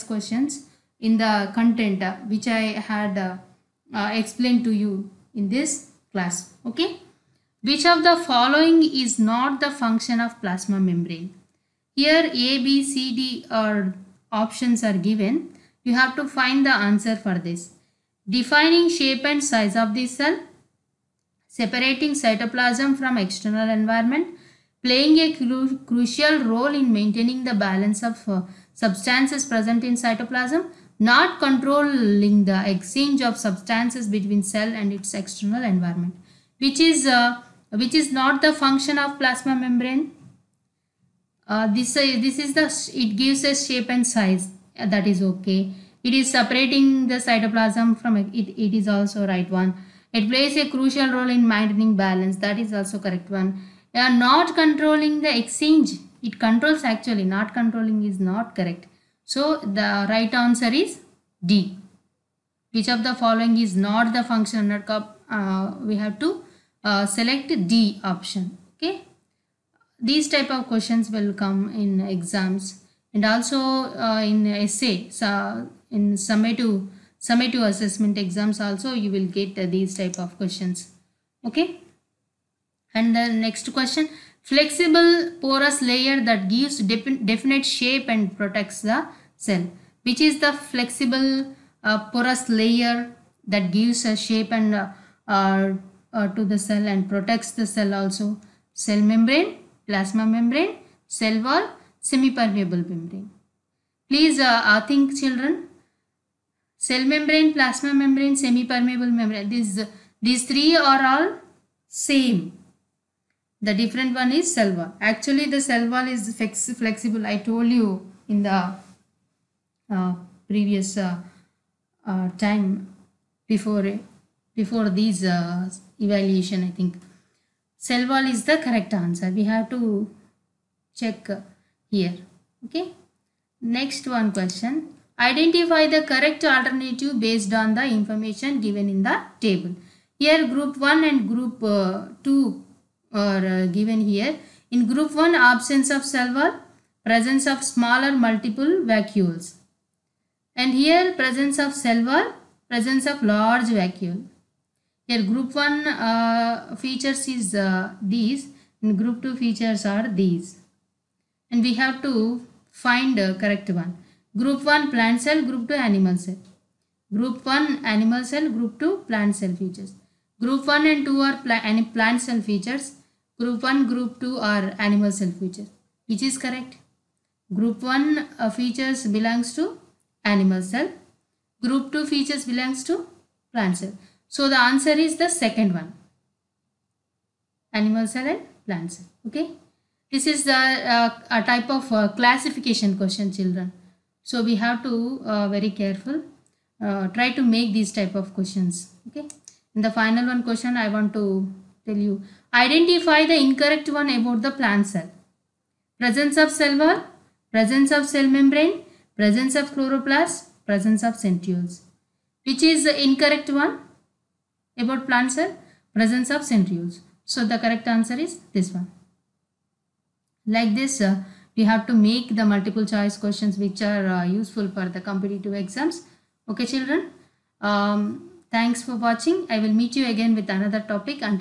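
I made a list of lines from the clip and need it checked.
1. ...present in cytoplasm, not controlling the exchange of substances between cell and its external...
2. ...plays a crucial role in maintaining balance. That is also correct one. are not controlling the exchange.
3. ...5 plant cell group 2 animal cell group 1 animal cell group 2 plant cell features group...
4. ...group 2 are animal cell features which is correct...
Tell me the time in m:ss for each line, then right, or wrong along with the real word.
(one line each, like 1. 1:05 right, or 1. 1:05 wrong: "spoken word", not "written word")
1. 0:29 right
2. 0:50 right
3. 2:44 wrong: "1", not "5"
4. 2:53 right.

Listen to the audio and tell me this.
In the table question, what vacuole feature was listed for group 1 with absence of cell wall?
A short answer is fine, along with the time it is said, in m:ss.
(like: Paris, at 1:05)
Smaller multiple vacuoles, at 2:27.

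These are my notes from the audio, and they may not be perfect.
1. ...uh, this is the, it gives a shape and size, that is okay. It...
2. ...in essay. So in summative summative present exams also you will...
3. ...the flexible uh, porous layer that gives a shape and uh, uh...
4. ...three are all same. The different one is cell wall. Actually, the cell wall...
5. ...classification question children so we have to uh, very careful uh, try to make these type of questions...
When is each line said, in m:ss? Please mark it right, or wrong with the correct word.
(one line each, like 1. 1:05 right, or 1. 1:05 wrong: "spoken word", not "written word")
1. 0:41 right
2. 1:14 wrong: "assessment", not "present"
3. 1:30 right
4. 1:50 right
5. 3:12 right.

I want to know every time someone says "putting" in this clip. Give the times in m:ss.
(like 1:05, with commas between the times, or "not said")
not said.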